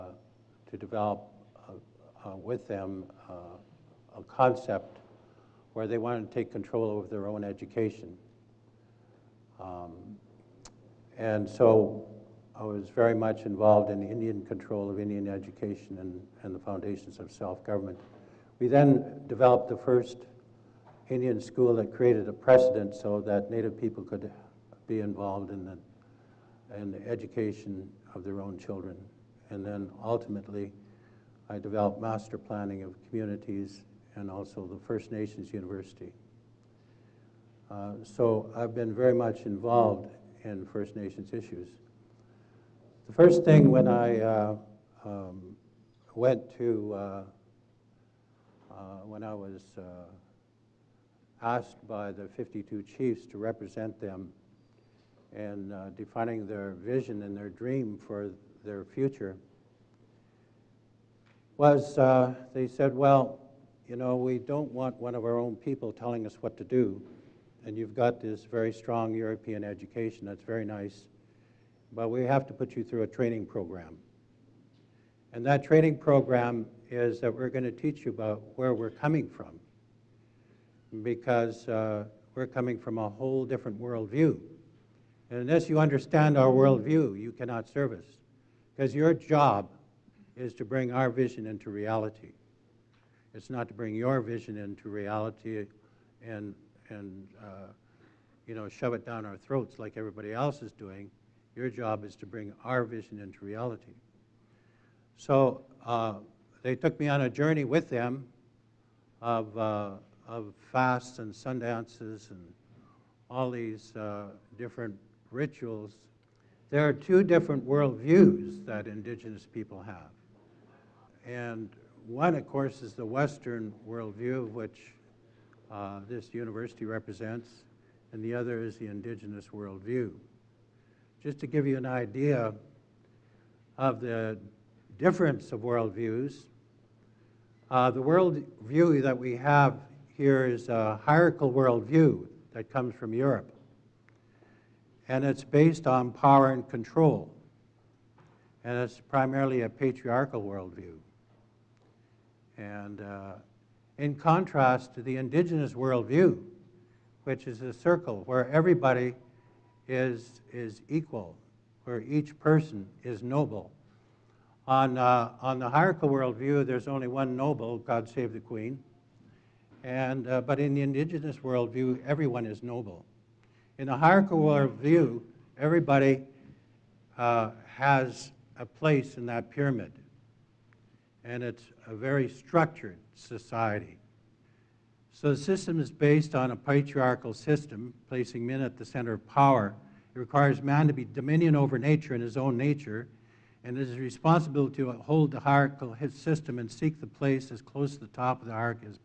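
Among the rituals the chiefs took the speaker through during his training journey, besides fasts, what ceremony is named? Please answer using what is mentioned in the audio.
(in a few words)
sundances.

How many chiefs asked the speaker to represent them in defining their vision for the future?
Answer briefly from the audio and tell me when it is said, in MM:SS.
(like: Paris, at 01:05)
52, at 00:52.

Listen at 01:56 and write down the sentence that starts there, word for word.
There are two different worldviews that indigenous people have.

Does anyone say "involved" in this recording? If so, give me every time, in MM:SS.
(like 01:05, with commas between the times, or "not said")
00:13, 00:25, 00:39.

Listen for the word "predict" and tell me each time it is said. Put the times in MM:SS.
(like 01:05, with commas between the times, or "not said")
not said.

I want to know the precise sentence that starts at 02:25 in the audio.
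And it's based on power and control.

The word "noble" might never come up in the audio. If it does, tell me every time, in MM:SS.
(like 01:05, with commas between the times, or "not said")
02:43, 02:47, 02:52.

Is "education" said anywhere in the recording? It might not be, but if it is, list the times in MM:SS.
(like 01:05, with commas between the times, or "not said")
00:07, 00:15, 00:27, 01:09.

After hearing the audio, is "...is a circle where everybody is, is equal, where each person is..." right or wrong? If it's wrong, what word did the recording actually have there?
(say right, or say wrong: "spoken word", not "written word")
right.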